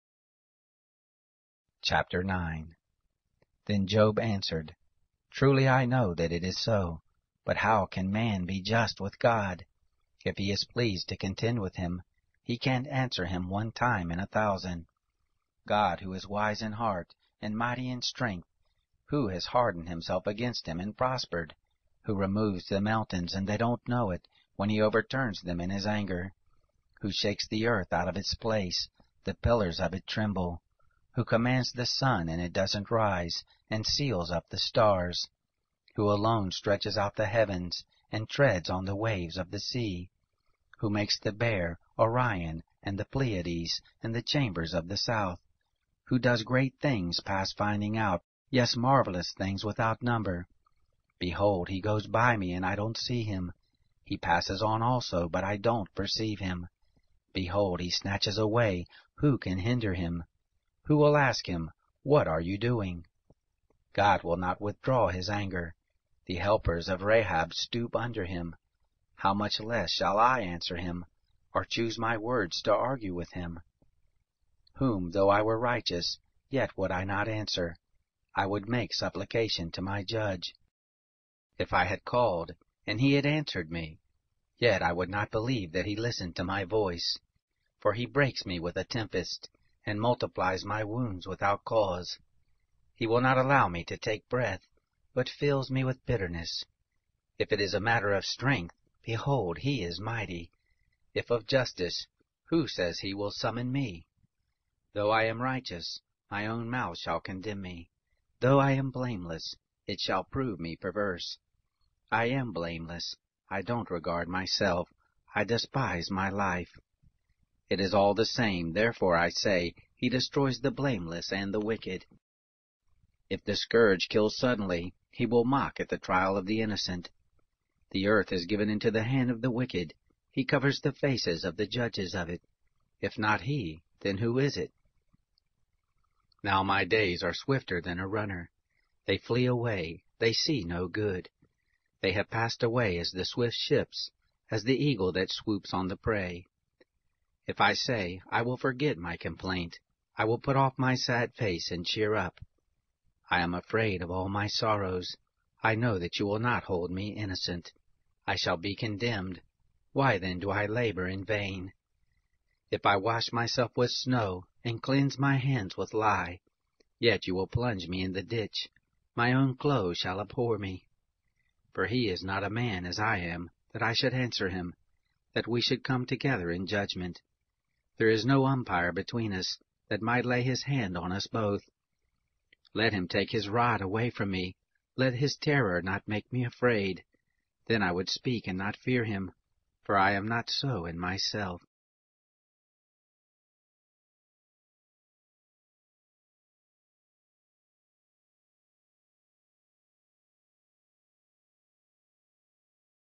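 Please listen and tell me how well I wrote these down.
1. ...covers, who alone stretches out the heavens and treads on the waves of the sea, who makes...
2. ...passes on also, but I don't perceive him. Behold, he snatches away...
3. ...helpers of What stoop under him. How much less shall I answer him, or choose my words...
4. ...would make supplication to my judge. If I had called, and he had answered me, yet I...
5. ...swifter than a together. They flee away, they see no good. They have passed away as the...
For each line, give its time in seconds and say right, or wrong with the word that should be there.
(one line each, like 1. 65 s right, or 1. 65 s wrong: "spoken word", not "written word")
1. 34 s wrong: "stars", not "covers"
2. 54 s right
3. 66 s wrong: "Rahab", not "What"
4. 78 s right
5. 137 s wrong: "runner", not "together".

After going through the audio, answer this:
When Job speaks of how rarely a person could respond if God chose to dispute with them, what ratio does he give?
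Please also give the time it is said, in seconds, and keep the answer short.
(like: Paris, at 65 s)
one time in a thousand, at 13 s.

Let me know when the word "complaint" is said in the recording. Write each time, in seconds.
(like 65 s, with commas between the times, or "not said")
149 s.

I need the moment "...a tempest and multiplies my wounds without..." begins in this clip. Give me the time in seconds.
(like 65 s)
88 s.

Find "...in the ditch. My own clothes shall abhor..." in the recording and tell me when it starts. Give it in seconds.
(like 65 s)
168 s.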